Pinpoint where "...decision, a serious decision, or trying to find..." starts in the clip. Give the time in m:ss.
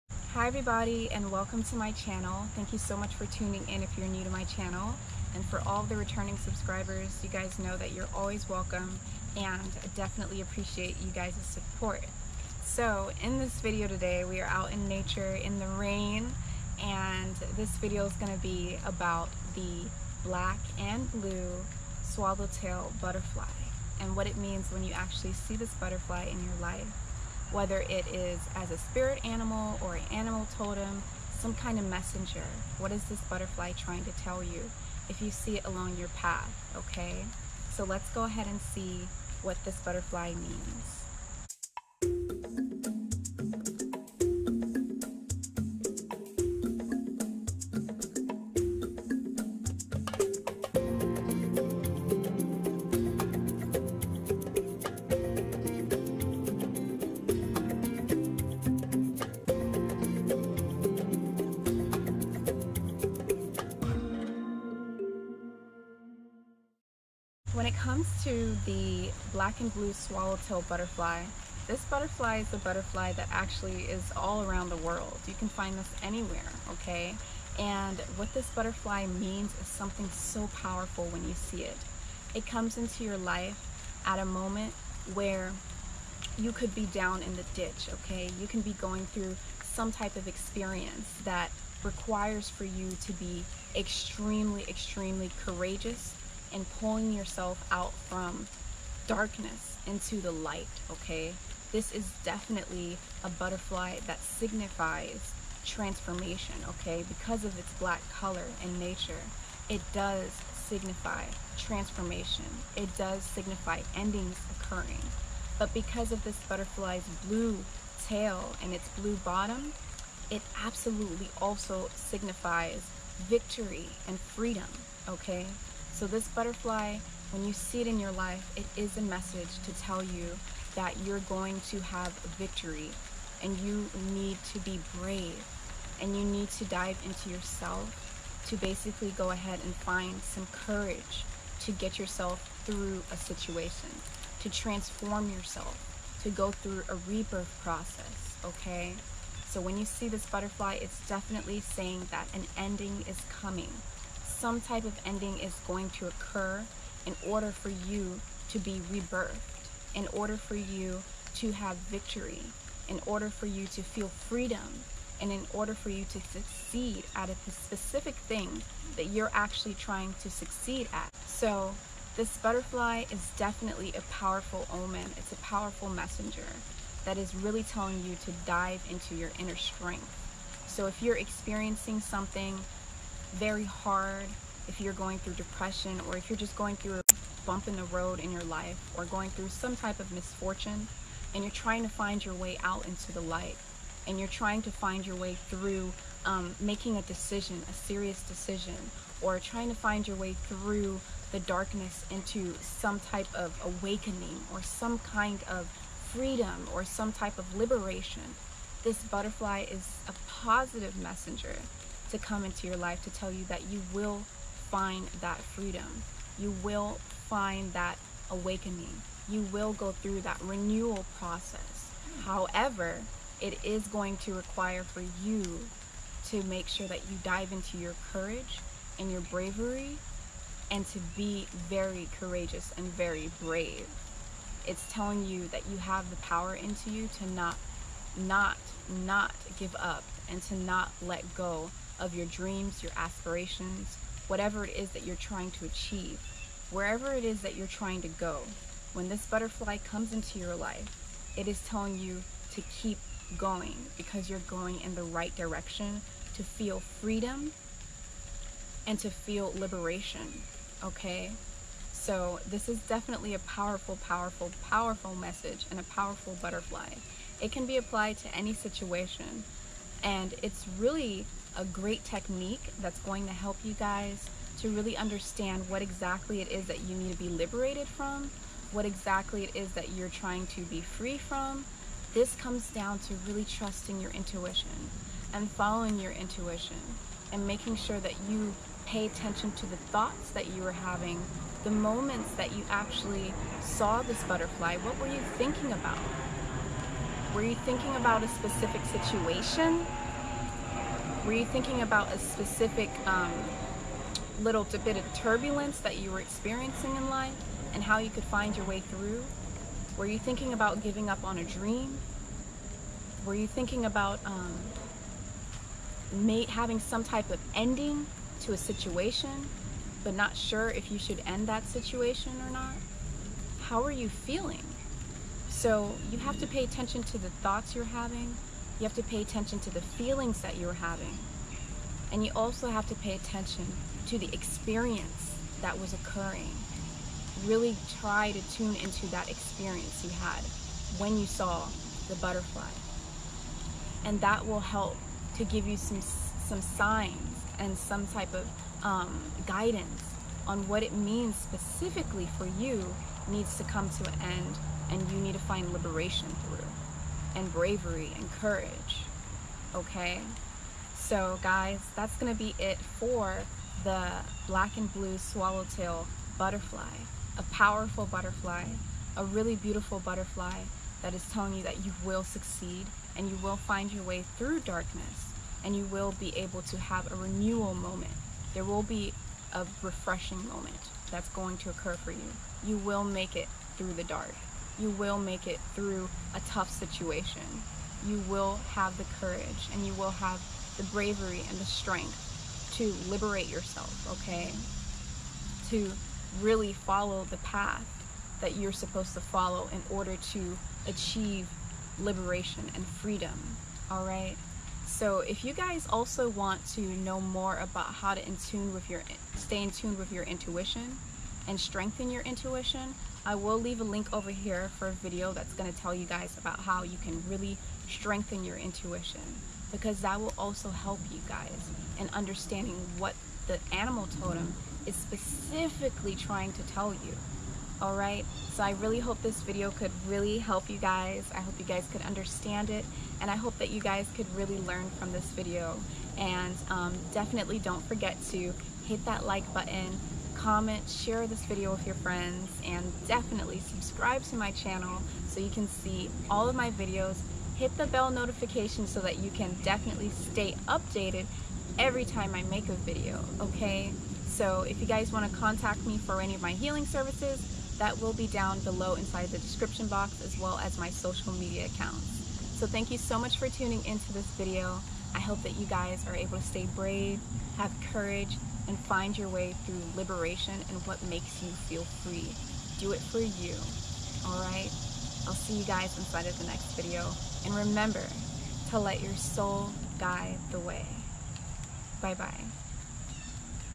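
3:17.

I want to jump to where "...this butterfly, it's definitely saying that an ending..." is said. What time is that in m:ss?
2:30.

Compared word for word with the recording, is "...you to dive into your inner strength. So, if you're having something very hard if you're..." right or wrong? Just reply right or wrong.
wrong.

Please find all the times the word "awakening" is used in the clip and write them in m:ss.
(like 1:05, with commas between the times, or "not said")
3:23, 3:38.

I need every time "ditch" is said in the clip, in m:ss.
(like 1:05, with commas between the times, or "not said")
1:27.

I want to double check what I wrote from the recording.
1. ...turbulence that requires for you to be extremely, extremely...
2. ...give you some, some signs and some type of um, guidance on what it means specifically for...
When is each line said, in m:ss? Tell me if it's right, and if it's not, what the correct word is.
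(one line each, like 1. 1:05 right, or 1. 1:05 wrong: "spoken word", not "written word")
1. 1:30 wrong: "experience", not "turbulence"
2. 5:45 right.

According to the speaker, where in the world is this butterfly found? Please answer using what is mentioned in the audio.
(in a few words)
All around the world.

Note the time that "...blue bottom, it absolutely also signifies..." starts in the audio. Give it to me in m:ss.
1:58.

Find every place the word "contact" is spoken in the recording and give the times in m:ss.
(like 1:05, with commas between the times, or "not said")
7:35.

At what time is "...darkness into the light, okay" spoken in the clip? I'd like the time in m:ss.
1:39.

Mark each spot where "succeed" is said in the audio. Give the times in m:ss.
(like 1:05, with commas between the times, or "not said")
2:46, 2:50, 6:12.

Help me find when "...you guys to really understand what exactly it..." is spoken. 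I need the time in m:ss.
4:33.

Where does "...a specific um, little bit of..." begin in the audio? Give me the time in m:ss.
5:02.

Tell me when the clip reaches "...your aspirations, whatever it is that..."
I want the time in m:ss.
4:02.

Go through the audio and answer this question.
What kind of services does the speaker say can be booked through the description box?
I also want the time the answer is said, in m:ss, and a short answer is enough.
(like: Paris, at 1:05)
Healing services, at 7:36.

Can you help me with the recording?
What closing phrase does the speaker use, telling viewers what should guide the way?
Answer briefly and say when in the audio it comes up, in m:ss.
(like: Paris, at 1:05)
Your soul, at 7:58.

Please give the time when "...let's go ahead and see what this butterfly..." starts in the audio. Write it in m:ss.
0:37.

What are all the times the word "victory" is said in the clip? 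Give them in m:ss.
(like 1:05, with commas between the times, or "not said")
2:03, 2:12, 2:41.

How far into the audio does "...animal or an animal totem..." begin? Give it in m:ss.
0:29.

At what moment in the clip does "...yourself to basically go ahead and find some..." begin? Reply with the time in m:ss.
2:17.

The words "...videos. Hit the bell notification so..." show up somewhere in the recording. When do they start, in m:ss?
7:26.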